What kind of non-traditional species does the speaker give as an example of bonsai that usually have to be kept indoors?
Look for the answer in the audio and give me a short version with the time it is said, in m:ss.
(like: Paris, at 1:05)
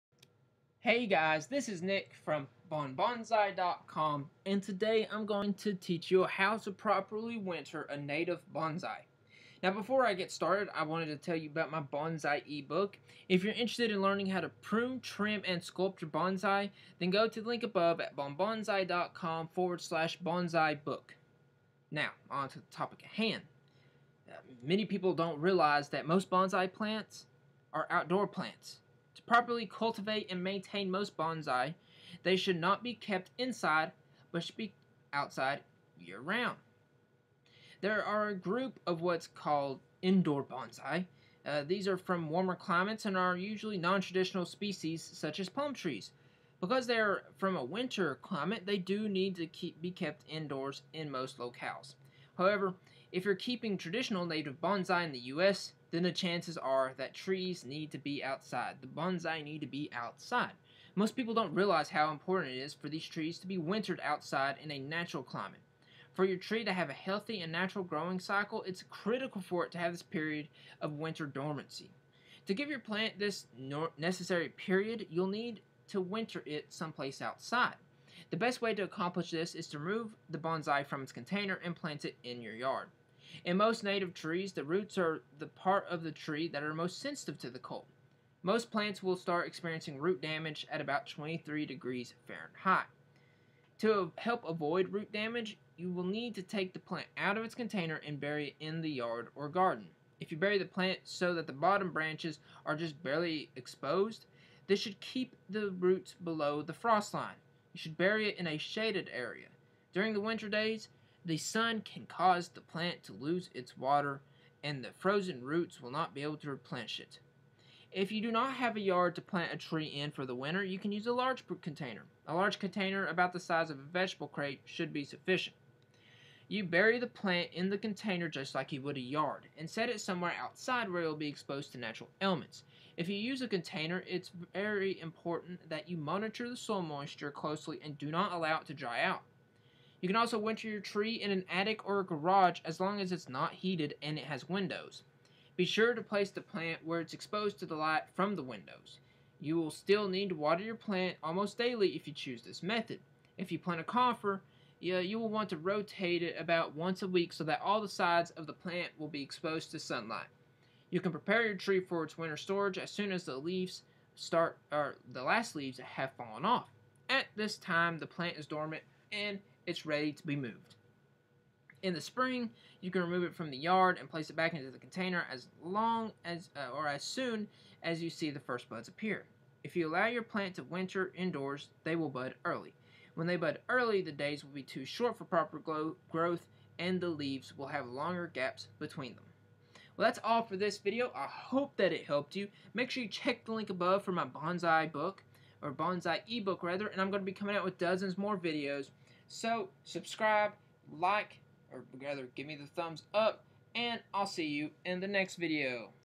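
palm trees, at 0:45.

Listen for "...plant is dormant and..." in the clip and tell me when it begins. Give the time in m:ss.
2:48.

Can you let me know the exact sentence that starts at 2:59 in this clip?
If you allow your plant to winter indoors, they will bud early.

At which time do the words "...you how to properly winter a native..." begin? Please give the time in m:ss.
0:06.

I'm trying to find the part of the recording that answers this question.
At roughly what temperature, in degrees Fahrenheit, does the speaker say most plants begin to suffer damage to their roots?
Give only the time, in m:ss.
1:31.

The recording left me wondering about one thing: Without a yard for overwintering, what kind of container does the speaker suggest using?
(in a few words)
vegetable crate.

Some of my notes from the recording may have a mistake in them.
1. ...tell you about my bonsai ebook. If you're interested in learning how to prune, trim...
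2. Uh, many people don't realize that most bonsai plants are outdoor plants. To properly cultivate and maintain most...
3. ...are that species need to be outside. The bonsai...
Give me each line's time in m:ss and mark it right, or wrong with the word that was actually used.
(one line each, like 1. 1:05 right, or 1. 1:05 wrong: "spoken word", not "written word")
1. 0:11 right
2. 0:24 right
3. 0:56 wrong: "trees", not "species".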